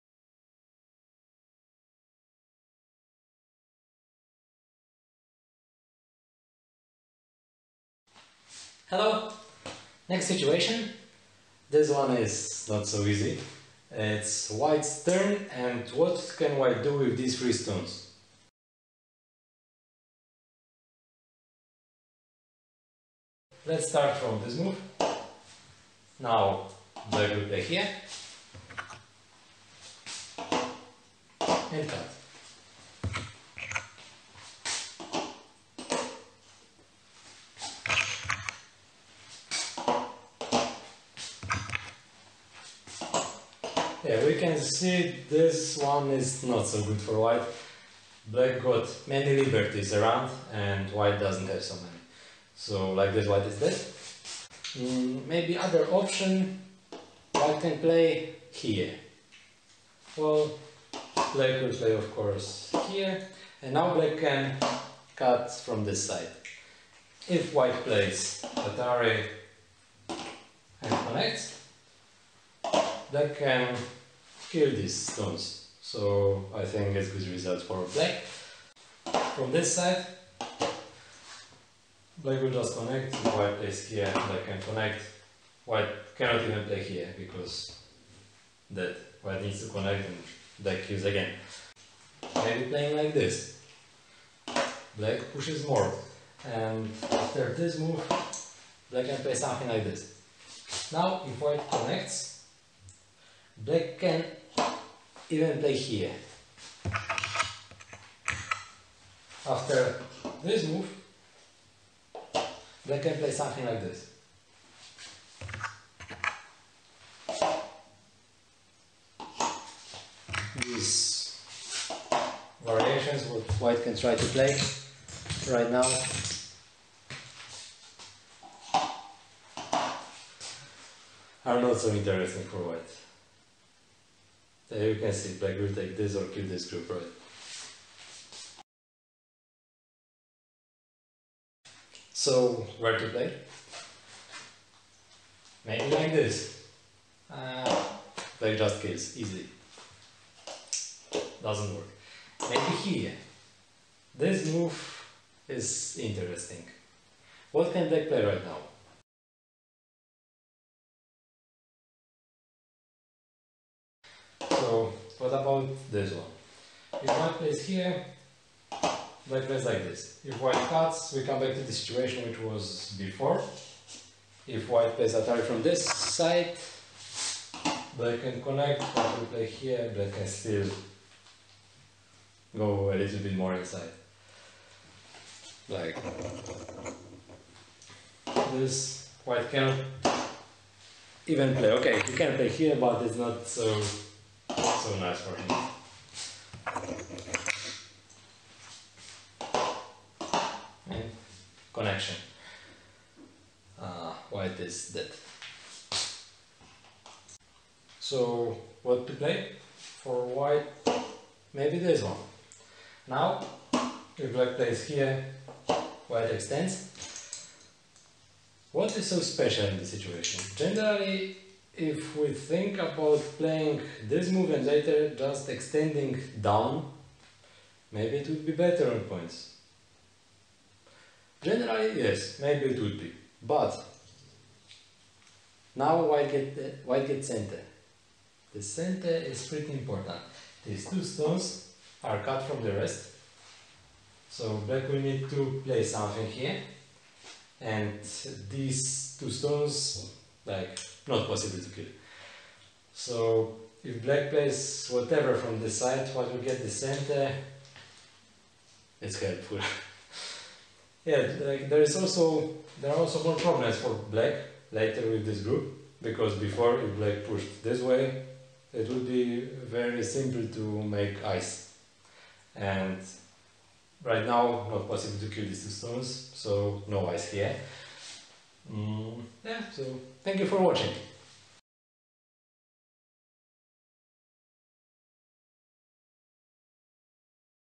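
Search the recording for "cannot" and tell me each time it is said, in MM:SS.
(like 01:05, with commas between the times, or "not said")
01:26, 03:09.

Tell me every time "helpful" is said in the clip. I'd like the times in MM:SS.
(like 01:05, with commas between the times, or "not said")
04:19.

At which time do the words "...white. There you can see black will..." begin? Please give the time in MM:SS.
02:12.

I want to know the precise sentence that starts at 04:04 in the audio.
So black will need to play something here.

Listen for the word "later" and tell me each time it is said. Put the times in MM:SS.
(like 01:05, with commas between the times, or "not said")
03:44, 04:24.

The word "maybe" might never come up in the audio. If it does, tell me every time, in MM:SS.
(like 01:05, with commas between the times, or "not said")
00:55, 01:32, 02:25, 02:32, 03:31, 03:47, 03:52.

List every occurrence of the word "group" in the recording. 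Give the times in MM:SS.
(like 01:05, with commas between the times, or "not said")
02:16, 04:25.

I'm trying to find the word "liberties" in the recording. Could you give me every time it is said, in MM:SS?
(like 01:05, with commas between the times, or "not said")
00:49.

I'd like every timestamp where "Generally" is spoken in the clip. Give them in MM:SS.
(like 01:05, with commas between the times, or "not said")
03:40, 03:51.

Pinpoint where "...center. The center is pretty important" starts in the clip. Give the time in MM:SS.
03:57.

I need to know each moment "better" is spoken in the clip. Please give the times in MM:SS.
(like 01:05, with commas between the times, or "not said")
03:48.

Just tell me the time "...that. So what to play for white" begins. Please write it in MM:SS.
03:24.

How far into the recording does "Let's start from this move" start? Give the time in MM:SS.
00:23.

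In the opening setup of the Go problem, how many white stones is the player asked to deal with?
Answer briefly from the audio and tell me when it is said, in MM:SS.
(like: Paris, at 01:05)
3, at 00:17.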